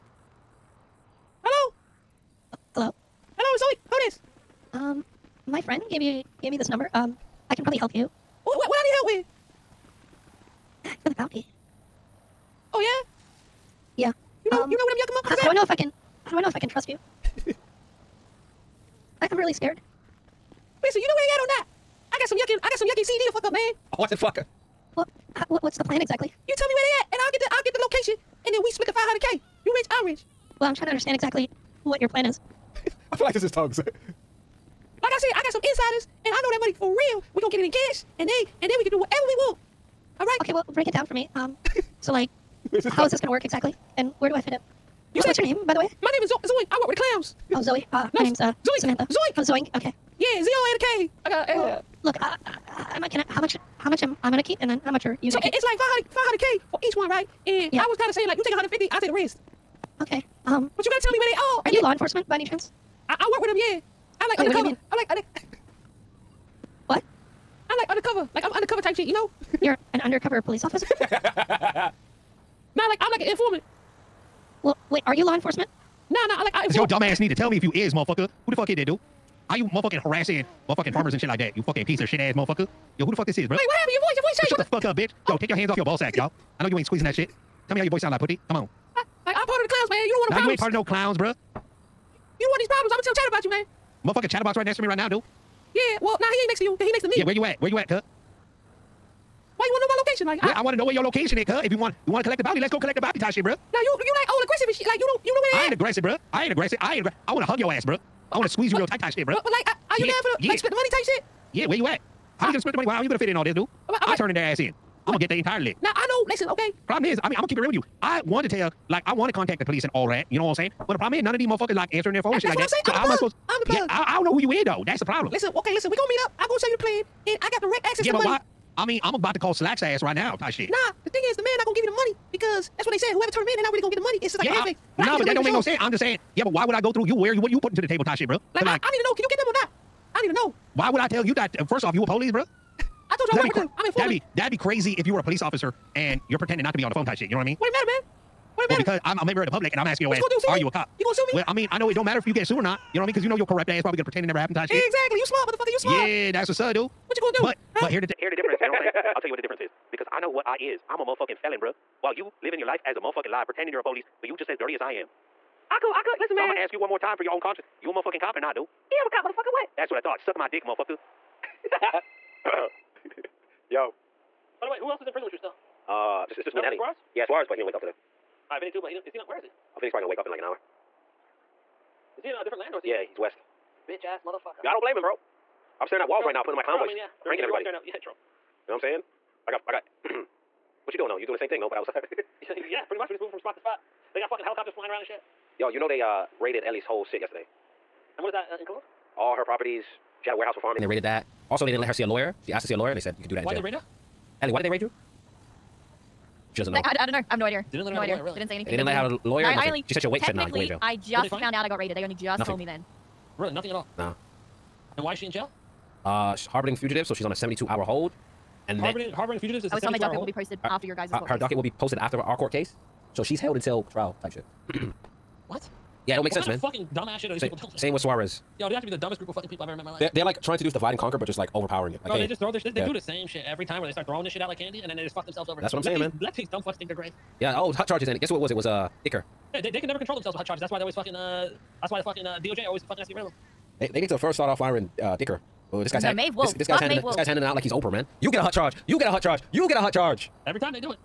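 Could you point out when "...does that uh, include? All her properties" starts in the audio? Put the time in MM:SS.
03:18.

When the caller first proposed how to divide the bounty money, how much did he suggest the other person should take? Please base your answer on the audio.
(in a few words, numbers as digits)
150.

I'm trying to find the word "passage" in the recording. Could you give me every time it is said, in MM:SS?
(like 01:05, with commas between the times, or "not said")
not said.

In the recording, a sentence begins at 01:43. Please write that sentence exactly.
Now you you like all aggressive and shit.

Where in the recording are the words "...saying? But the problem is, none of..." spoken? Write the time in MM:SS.
02:00.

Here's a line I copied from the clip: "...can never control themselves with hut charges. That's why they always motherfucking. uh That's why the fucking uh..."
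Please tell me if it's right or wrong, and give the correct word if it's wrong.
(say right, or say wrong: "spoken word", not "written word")
wrong: "fucking", not "motherfucking".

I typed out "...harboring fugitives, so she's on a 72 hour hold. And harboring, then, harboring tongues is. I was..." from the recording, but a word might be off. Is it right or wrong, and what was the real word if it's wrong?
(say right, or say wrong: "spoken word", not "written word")
wrong: "fugitives", not "tongues".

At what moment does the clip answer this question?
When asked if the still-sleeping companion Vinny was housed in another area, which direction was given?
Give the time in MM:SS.
03:03.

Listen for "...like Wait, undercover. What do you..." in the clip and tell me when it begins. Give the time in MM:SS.
01:04.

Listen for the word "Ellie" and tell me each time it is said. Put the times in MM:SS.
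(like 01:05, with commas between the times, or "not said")
02:56, 03:16, 03:24.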